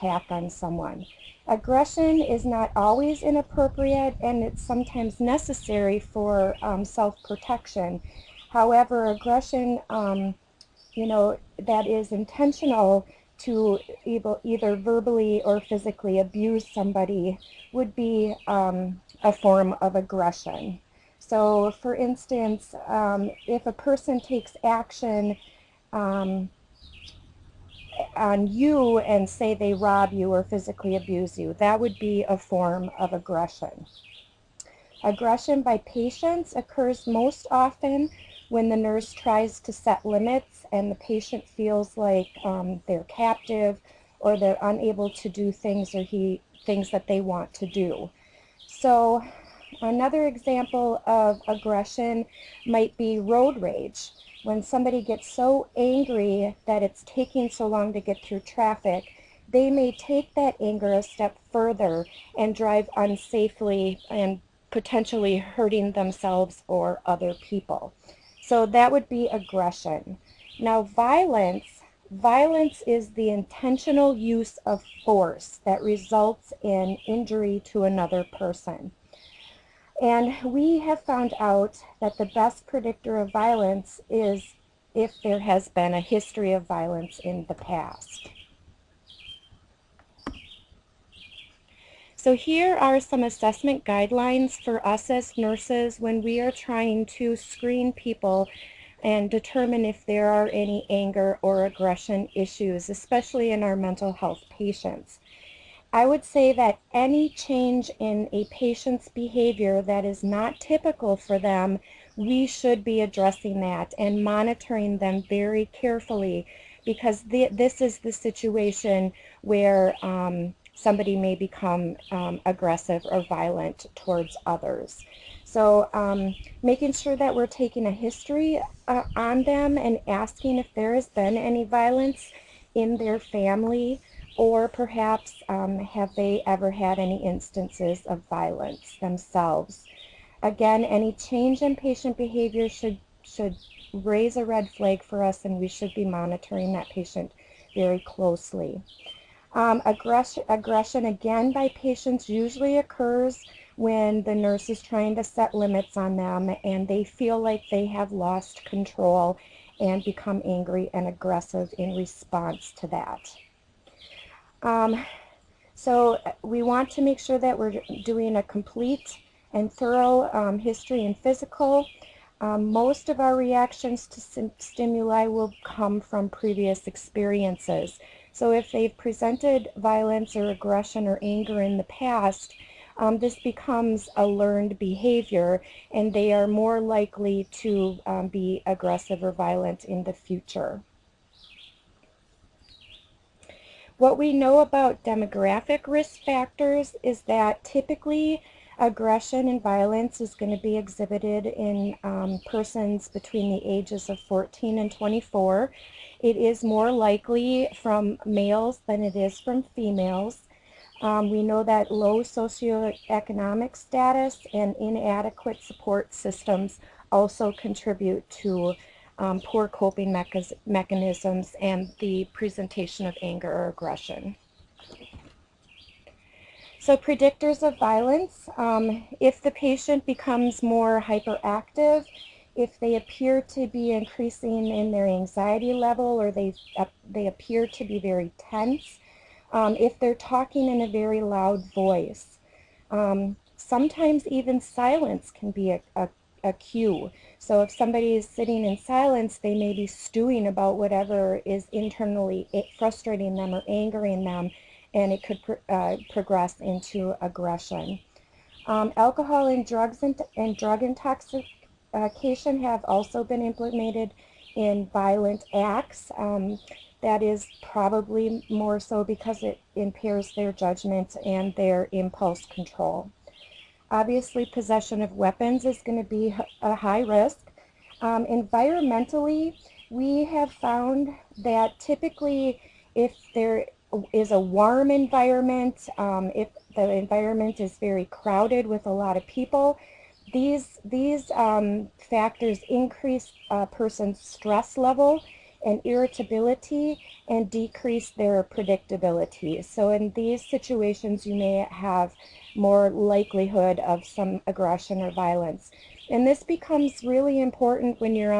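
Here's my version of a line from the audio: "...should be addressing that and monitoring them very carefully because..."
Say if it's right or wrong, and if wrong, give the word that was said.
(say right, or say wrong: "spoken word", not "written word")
right.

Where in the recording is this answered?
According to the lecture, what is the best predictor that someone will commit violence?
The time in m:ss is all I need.
1:26.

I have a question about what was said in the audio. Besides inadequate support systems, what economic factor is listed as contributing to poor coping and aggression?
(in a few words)
low socioeconomic status.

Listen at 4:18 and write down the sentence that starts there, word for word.
Um, alcohol and drugs and, and drug intoxication have also been implemented in violent acts.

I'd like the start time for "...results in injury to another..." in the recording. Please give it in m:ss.
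1:15.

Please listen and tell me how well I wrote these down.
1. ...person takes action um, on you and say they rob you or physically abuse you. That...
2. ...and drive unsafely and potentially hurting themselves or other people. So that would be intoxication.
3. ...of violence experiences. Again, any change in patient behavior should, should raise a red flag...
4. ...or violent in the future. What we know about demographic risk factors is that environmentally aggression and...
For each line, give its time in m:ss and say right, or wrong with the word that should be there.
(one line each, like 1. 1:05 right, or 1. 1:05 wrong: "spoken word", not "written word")
1. 0:23 right
2. 1:02 wrong: "aggression", not "intoxication"
3. 2:18 wrong: "themselves", not "experiences"
4. 3:09 wrong: "typically", not "environmentally".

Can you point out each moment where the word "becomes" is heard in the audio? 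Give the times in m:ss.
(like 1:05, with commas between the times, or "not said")
2:01, 2:40, 3:03, 3:50, 5:06.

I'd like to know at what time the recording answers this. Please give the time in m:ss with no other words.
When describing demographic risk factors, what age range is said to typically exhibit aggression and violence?
3:24.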